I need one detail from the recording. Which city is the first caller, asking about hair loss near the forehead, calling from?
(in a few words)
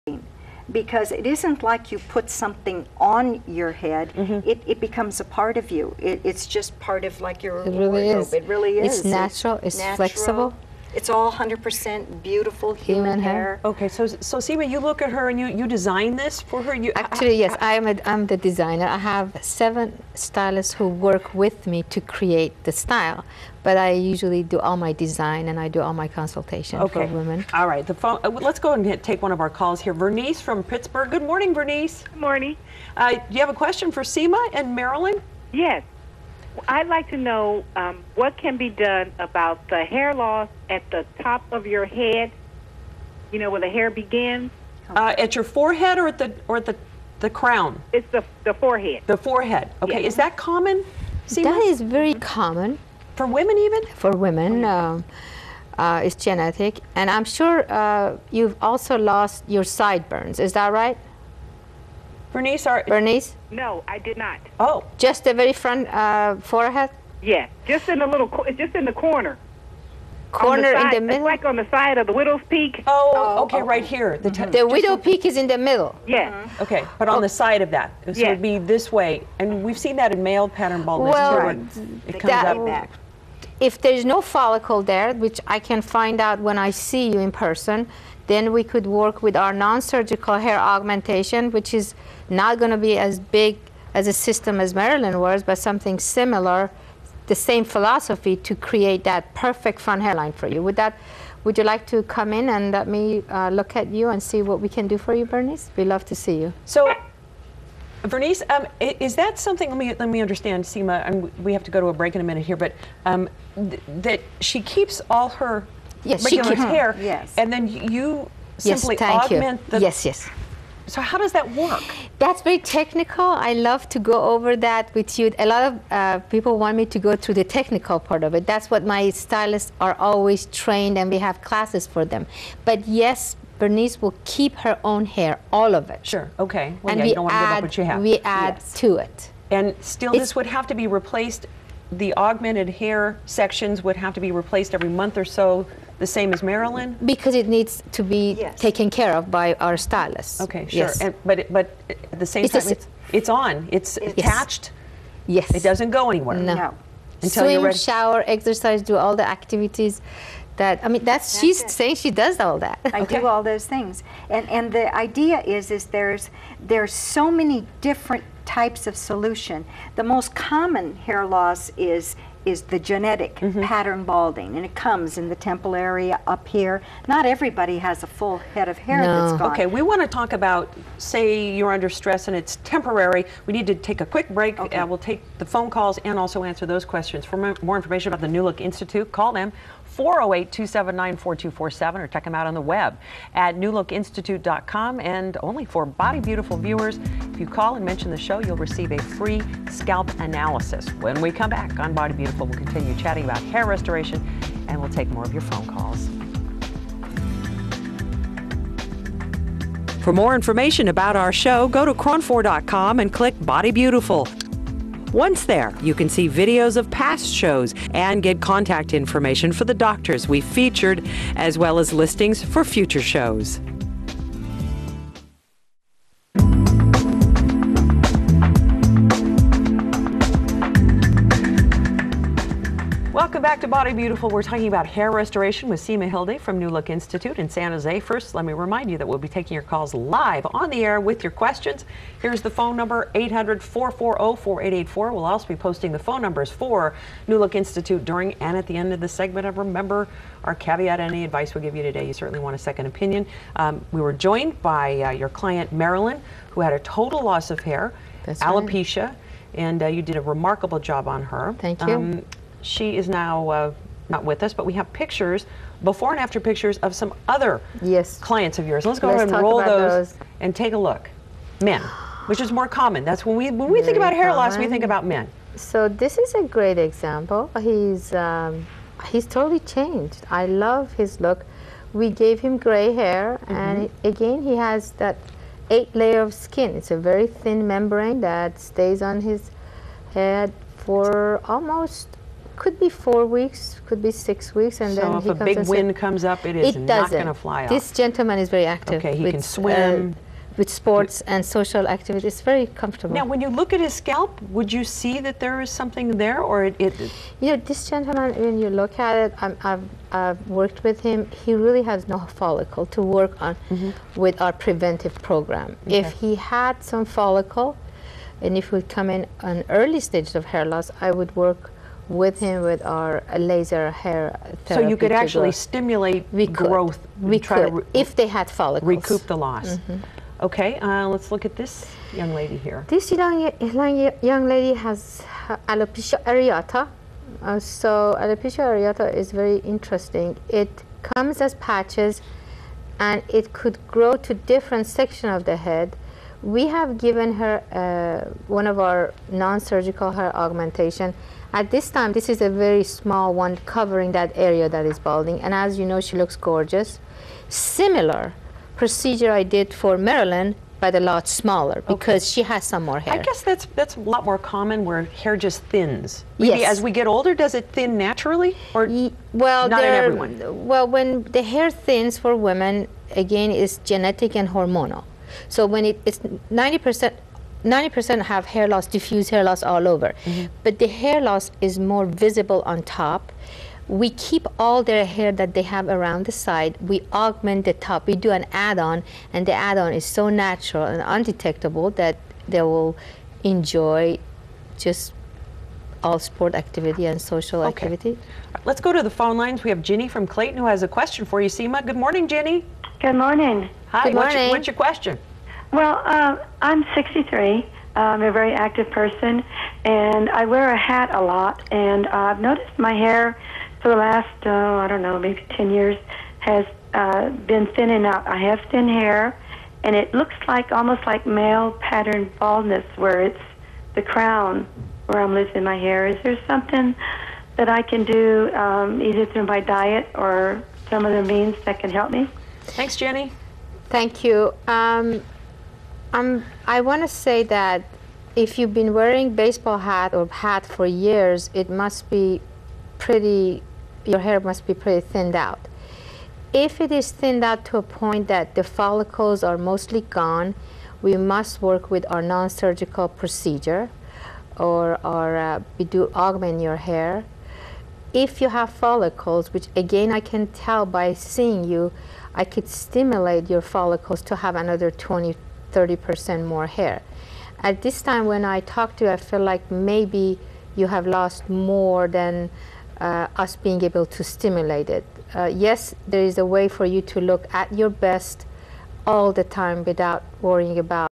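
Pittsburg.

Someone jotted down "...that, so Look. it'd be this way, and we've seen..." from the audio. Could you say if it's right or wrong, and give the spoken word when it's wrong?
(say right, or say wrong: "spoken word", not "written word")
wrong: "Yeah", not "Look".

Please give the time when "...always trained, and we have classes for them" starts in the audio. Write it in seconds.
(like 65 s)
129 s.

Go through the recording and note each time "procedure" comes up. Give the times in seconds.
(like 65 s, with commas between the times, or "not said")
358 s, 453 s.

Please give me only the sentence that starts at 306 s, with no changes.
it you know, this gentleman, when you look at it, i have I've worked with him.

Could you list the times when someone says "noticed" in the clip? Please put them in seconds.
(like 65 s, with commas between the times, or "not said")
412 s.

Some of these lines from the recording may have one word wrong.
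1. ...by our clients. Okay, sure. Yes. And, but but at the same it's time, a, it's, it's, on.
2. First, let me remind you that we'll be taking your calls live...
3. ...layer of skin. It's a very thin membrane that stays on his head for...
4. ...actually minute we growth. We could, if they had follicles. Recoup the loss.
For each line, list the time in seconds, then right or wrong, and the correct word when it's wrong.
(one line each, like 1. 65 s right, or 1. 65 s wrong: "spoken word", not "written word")
1. 149 s wrong: "stylists", not "clients"
2. 238 s right
3. 286 s right
4. 325 s wrong: "stimulate", not "minute".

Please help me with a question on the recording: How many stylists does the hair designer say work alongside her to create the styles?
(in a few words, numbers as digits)
7.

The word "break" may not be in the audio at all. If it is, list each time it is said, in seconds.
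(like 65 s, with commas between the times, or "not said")
111 s, 184 s.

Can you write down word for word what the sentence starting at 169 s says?
The most common hair loss is is the genetic mm-hmm.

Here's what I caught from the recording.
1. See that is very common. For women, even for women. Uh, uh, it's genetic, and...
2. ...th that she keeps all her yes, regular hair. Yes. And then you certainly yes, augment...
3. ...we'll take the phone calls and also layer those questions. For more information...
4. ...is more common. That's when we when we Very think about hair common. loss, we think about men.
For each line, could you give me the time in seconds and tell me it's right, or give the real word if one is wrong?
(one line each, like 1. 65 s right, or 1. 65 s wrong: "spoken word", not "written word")
1. 51 s right
2. 113 s wrong: "simply", not "certainly"
3. 184 s wrong: "answer", not "layer"
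4. 272 s right.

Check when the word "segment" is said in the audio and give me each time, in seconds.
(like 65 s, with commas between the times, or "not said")
249 s.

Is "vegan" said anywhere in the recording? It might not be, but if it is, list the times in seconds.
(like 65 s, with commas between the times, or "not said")
not said.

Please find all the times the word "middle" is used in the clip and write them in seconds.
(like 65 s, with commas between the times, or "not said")
71 s, 75 s.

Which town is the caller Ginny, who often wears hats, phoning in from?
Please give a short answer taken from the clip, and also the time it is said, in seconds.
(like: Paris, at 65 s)
Clayton, at 400 s.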